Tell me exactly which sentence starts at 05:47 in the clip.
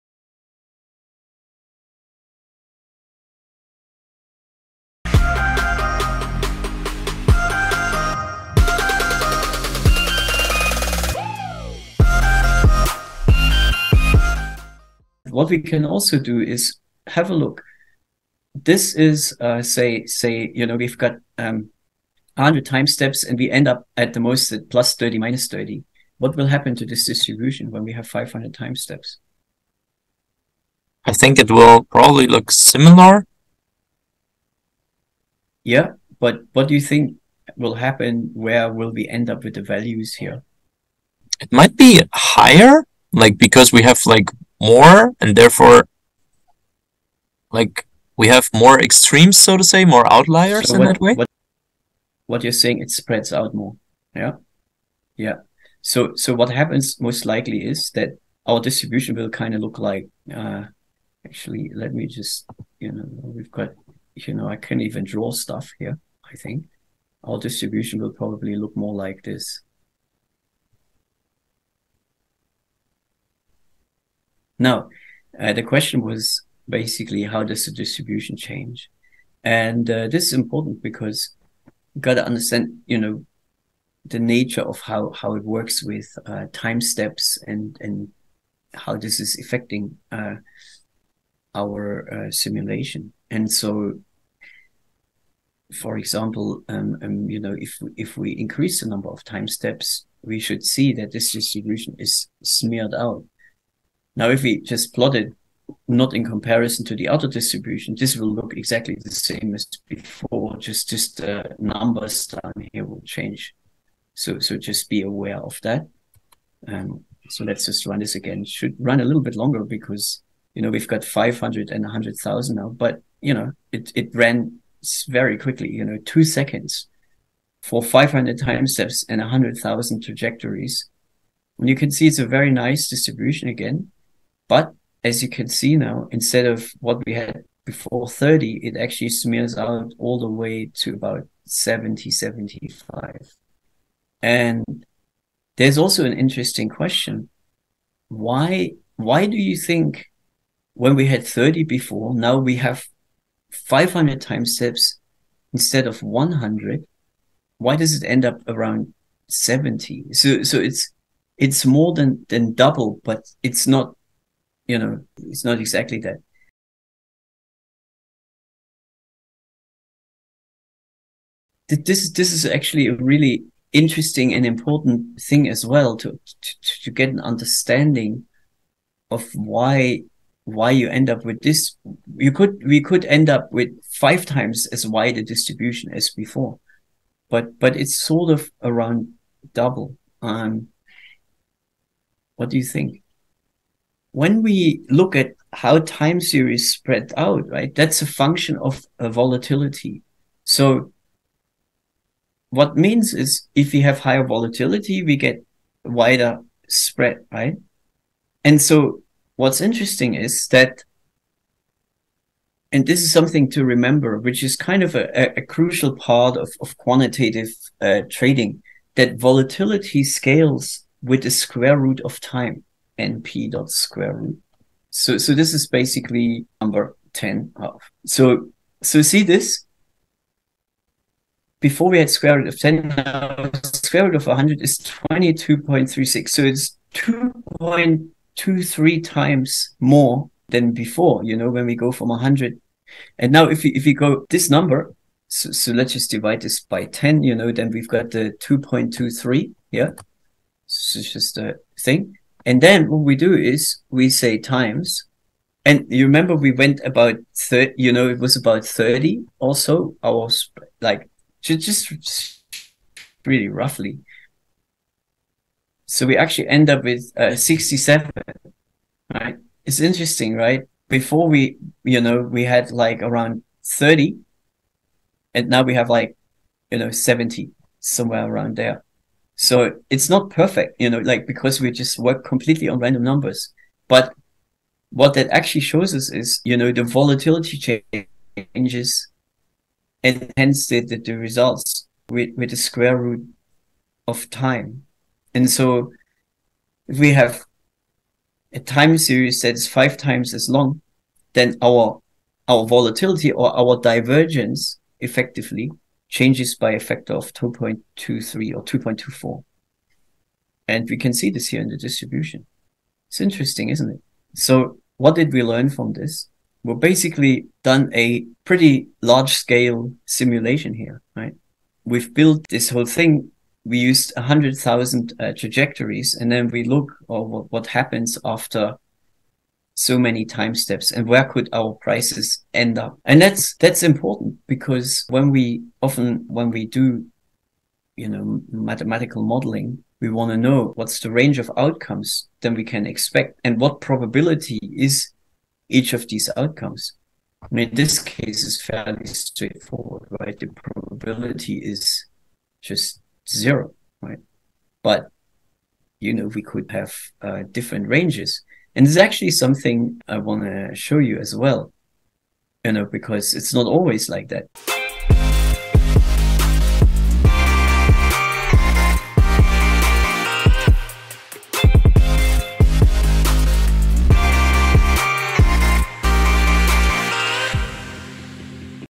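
And in this case, is fairly straightforward, right?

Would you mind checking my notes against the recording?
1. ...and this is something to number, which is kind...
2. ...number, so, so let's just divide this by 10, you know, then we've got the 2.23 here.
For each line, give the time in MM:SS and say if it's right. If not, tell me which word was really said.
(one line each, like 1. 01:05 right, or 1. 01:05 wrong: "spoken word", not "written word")
1. 03:32 wrong: "remember", not "number"
2. 04:04 right.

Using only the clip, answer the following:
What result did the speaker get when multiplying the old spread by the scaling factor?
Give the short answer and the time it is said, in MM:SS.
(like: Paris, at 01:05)
67, at 04:27.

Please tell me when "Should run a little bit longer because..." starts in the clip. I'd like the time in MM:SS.
01:58.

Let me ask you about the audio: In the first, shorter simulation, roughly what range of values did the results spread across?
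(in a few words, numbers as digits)
plus 30 minus 30.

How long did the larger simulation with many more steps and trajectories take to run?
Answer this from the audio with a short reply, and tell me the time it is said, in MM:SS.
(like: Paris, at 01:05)
2 seconds, at 02:06.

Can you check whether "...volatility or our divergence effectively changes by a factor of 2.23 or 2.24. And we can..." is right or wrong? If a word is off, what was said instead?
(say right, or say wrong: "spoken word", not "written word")
right.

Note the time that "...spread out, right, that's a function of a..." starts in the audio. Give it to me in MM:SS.
03:16.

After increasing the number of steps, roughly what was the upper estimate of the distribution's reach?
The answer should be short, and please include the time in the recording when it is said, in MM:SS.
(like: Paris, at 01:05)
75, at 02:22.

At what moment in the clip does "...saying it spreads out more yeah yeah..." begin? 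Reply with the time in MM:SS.
00:52.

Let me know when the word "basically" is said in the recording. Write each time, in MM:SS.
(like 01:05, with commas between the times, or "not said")
01:16, 03:45, 05:16.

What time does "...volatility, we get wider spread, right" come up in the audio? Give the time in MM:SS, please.
03:24.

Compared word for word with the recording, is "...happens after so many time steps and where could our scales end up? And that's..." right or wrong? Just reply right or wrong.
wrong.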